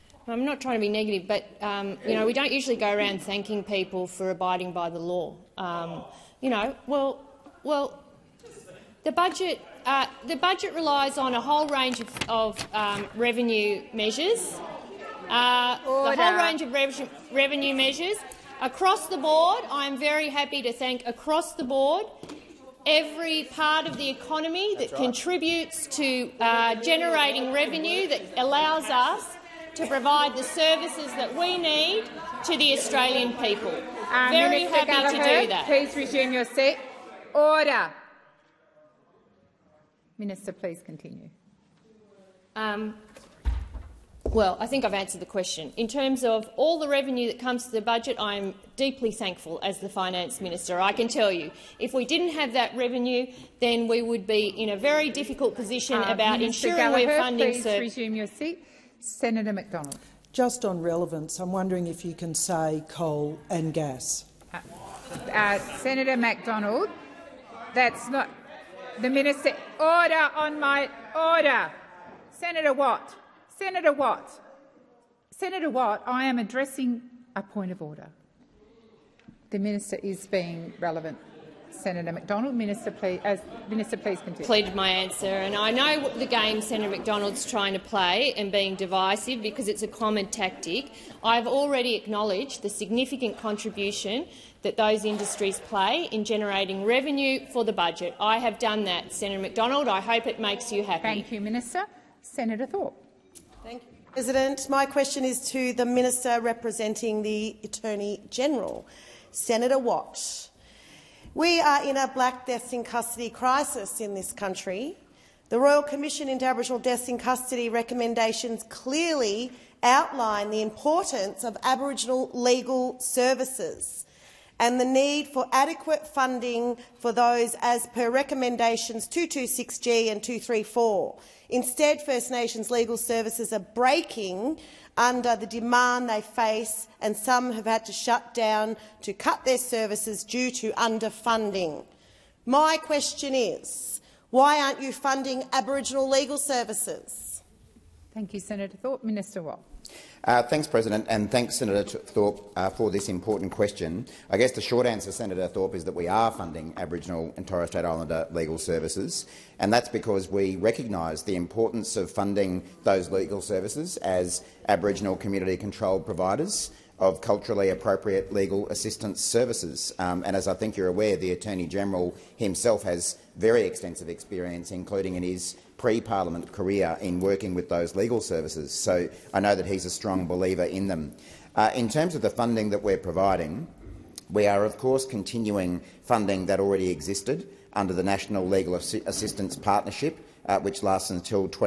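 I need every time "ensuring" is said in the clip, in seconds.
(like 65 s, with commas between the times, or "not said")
56 s.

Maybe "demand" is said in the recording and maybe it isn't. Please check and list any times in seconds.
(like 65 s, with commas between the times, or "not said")
135 s.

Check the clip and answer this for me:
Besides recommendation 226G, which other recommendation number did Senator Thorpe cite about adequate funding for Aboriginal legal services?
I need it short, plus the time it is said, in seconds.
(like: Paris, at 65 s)
234, at 130 s.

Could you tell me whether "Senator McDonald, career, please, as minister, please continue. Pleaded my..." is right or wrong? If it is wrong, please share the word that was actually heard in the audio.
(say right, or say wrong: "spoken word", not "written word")
wrong: "minister", not "career".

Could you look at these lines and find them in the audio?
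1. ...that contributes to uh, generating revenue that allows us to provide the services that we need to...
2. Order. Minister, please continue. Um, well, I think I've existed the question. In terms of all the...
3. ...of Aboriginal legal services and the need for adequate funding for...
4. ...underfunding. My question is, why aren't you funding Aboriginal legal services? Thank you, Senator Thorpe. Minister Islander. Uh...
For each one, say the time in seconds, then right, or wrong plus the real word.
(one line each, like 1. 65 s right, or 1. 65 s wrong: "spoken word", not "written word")
1. 24 s right
2. 37 s wrong: "answered", not "existed"
3. 121 s right
4. 140 s wrong: "Watt", not "Islander".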